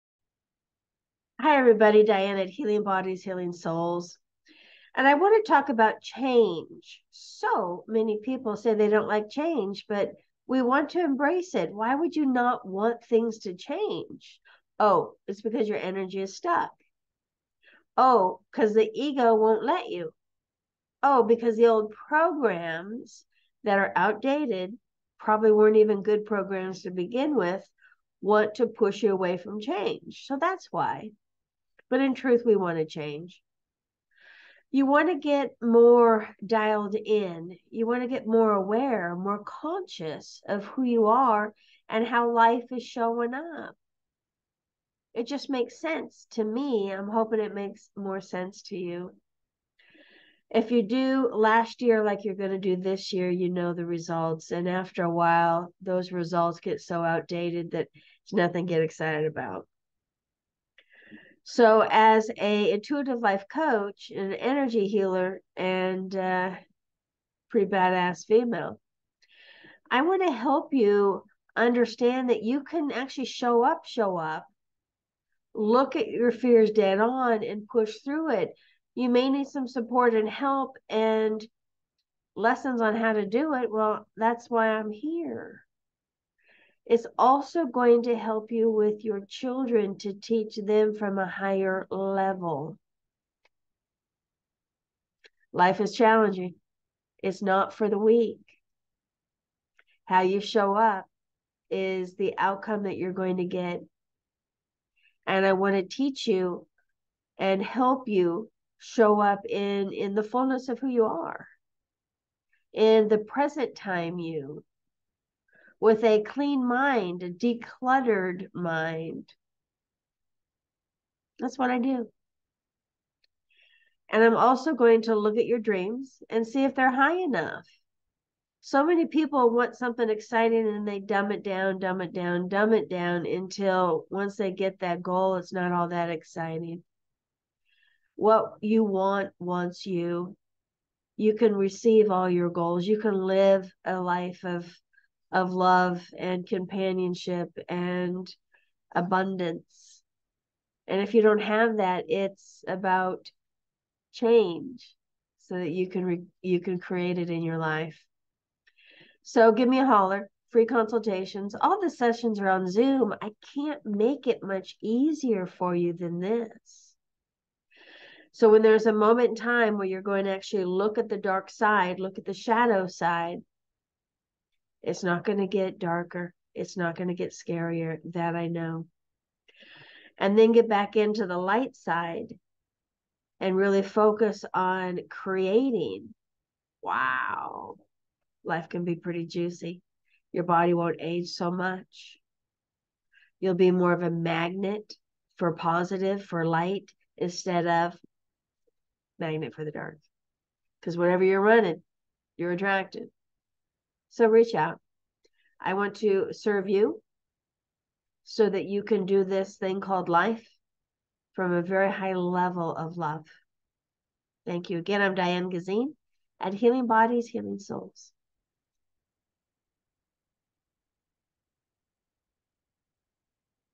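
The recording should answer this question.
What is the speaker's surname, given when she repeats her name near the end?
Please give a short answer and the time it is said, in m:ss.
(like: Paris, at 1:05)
Gysin, at 3:35.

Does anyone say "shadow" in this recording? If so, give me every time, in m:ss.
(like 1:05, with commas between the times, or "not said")
2:52.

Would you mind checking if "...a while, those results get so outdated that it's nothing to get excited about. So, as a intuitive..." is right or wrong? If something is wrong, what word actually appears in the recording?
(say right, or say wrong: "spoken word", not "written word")
right.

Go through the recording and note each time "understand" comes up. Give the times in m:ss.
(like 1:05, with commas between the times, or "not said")
1:11.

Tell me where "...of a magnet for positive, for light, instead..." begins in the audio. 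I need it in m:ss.
3:13.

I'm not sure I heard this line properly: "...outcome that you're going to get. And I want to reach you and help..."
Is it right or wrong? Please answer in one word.
wrong.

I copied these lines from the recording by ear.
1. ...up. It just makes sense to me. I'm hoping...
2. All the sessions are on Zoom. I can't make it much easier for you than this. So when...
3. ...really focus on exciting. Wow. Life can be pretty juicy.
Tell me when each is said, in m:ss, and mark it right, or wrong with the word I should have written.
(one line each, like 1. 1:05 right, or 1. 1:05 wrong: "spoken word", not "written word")
1. 0:43 right
2. 2:41 right
3. 3:03 wrong: "creating", not "exciting".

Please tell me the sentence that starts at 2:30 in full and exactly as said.
And if you don't have that, it's about change so that you can re- you can create it in your life.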